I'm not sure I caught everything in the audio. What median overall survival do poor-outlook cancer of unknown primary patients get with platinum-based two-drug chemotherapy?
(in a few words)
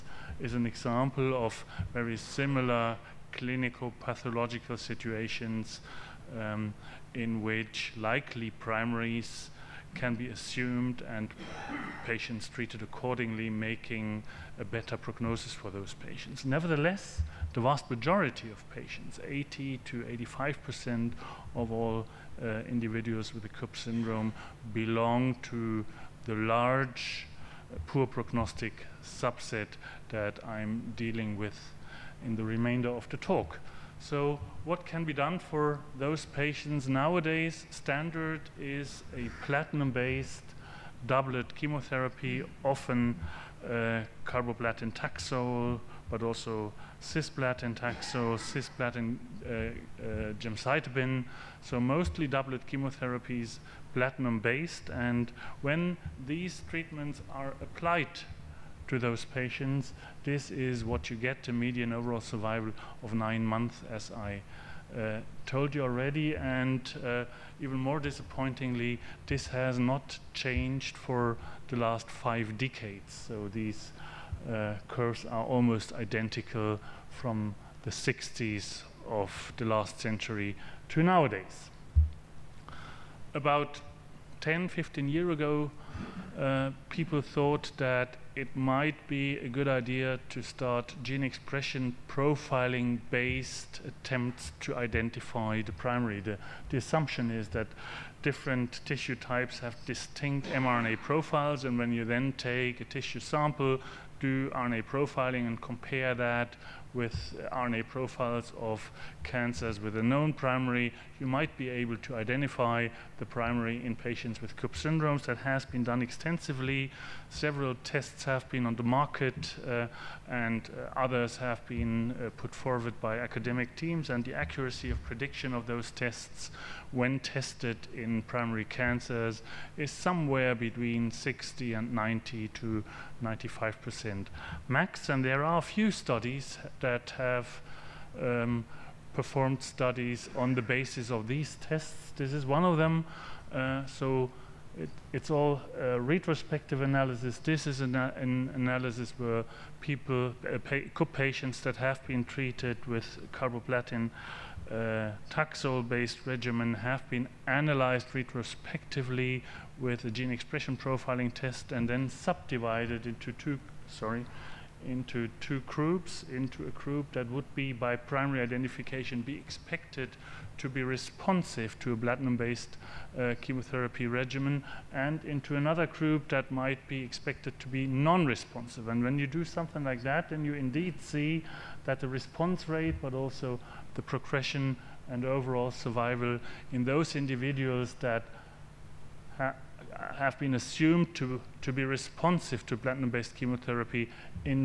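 9 months.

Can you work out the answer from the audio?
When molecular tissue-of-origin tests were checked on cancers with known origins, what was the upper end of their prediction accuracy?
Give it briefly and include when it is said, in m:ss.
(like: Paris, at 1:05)
95%, at 2:13.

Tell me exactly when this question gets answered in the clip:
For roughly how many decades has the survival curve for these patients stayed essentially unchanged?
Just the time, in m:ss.
1:12.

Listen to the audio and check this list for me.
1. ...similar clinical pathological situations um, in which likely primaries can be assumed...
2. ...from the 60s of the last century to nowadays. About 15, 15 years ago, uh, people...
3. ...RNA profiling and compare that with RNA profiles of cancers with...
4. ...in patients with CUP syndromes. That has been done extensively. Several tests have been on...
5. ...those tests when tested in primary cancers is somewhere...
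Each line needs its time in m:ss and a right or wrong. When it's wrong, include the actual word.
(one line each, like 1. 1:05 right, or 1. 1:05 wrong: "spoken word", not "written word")
1. 0:02 right
2. 1:17 wrong: "10", not "15"
3. 1:44 right
4. 1:53 right
5. 2:05 right.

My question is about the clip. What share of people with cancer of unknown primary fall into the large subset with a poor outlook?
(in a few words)
80 to 85%.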